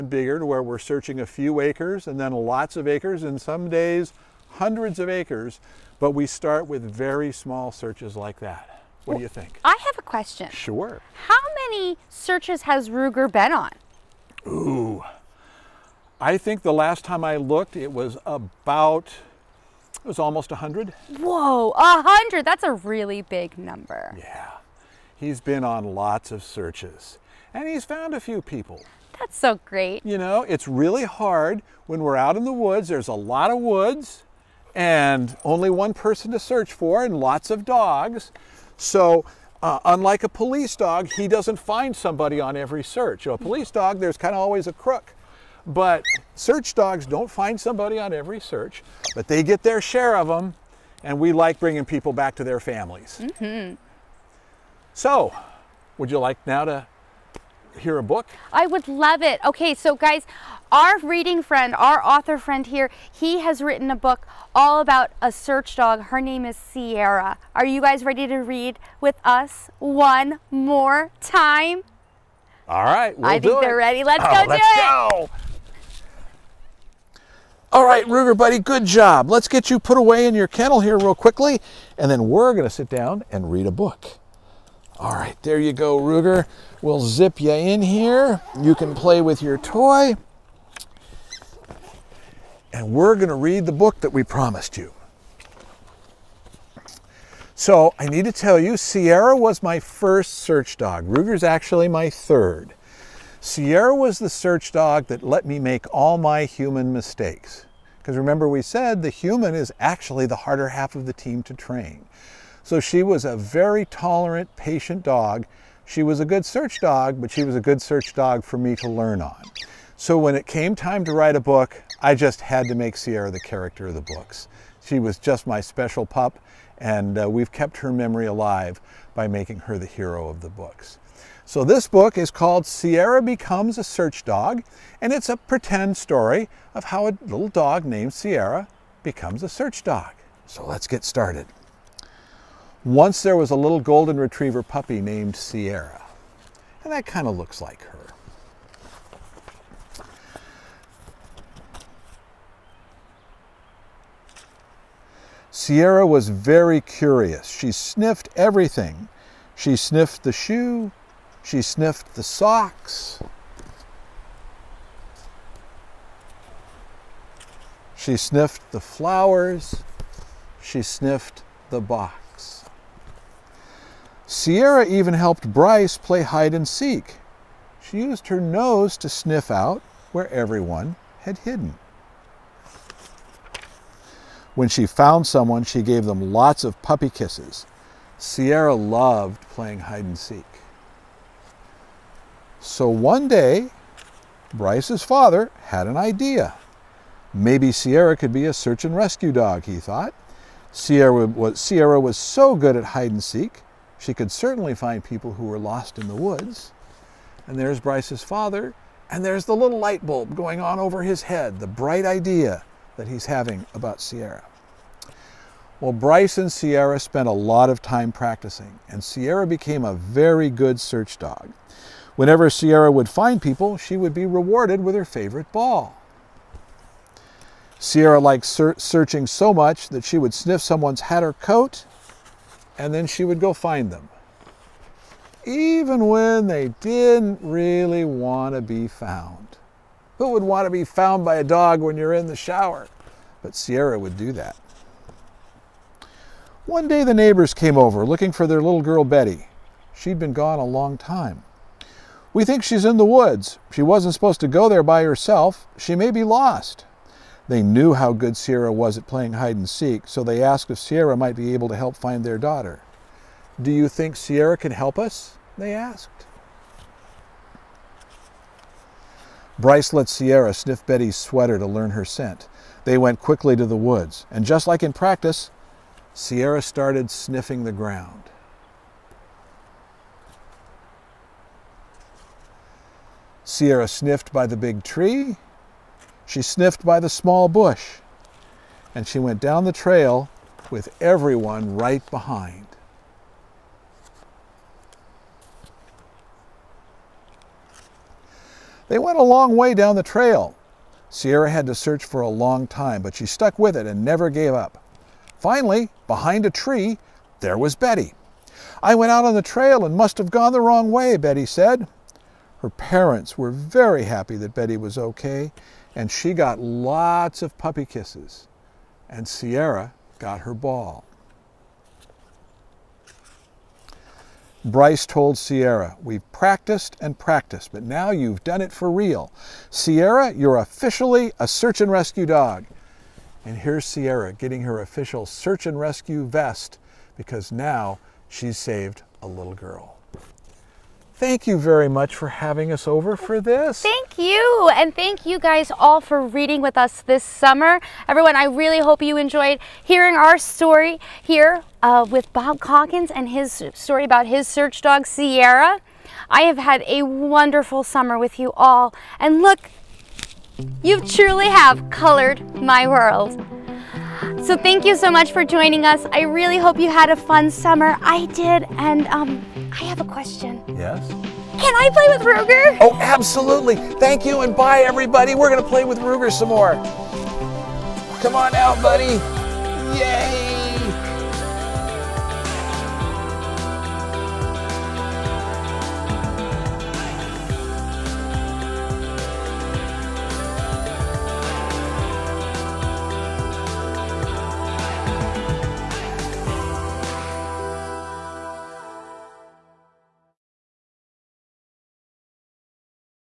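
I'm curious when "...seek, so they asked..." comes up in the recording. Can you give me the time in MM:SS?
04:19.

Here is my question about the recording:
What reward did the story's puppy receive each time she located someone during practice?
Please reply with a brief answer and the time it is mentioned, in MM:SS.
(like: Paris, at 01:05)
her favorite ball, at 03:44.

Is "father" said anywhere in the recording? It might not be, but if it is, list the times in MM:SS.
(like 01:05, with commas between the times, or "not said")
03:15, 03:28.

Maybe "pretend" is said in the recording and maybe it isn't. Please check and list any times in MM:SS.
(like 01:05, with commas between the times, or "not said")
02:15.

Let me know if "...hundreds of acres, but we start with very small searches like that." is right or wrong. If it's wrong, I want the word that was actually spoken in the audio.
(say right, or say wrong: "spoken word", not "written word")
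right.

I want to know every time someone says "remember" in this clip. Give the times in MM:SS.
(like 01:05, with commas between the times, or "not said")
01:48.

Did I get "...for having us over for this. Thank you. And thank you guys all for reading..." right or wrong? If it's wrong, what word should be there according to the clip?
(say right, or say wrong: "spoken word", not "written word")
right.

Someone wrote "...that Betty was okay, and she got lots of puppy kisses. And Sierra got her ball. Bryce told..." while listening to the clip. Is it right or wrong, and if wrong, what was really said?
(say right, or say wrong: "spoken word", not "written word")
right.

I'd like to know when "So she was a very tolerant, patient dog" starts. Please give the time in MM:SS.
01:52.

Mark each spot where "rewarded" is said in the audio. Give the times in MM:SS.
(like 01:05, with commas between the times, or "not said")
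03:44.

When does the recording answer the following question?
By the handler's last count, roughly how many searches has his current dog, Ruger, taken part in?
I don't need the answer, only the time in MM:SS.
00:20.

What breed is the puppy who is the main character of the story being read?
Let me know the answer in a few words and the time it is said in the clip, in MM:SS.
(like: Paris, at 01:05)
golden retriever, at 02:23.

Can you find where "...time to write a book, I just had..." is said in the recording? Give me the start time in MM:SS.
02:00.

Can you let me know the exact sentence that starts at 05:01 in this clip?
Sierra had to search for a long time, but she stuck with it and never gave up.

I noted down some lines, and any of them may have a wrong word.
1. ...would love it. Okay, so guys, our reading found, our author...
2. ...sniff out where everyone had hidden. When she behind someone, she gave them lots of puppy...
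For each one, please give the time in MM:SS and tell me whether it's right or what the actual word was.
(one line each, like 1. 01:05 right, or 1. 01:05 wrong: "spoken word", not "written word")
1. 00:58 wrong: "friend", not "found"
2. 02:59 wrong: "found", not "behind".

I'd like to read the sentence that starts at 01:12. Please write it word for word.
All right, we'll I think it.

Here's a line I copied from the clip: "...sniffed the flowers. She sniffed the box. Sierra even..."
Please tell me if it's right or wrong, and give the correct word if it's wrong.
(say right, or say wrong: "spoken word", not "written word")
right.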